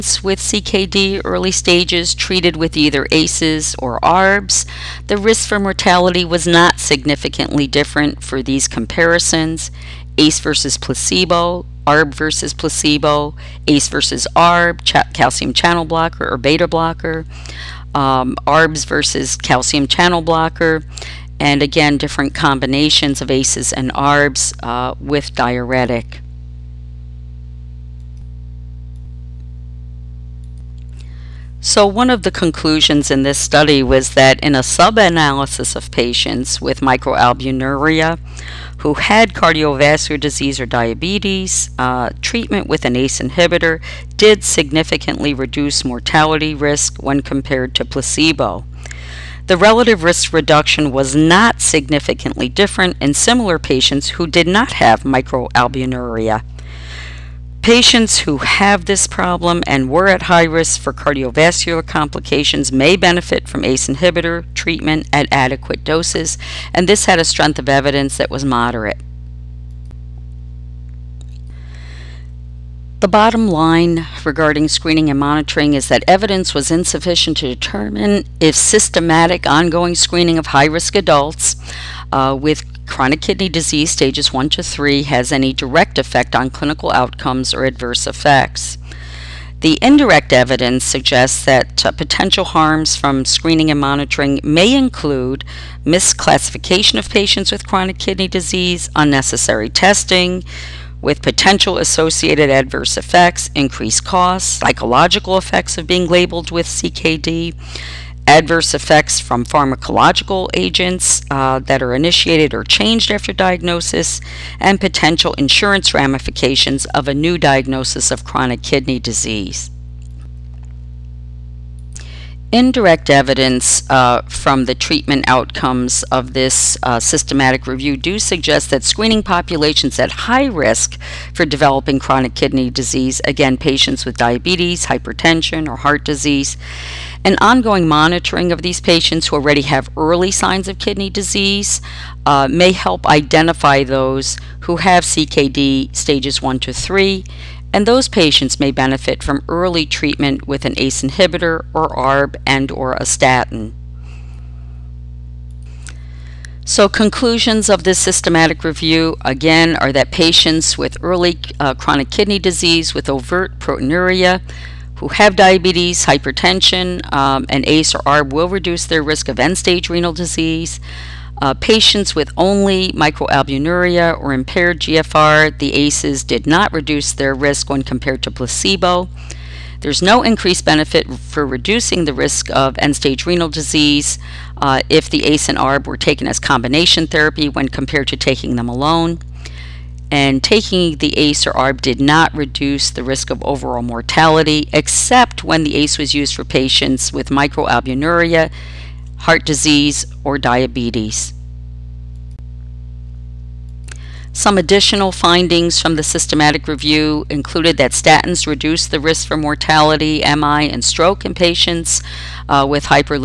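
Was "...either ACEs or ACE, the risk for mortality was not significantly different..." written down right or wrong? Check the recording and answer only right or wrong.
wrong.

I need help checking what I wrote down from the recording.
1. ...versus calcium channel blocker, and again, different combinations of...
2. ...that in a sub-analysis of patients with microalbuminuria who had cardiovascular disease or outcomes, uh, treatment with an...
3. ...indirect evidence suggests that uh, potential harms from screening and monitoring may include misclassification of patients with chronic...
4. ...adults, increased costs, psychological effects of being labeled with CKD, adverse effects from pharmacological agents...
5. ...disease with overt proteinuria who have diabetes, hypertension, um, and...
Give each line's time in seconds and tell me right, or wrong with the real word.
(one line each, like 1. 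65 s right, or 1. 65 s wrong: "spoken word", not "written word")
1. 18 s right
2. 34 s wrong: "diabetes", not "outcomes"
3. 89 s right
4. 102 s wrong: "effects", not "adults"
5. 162 s right.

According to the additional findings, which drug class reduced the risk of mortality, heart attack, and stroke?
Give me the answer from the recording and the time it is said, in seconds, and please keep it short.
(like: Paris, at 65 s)
Statins, at 207 s.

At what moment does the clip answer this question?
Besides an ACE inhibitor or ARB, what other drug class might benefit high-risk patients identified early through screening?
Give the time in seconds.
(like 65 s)
152 s.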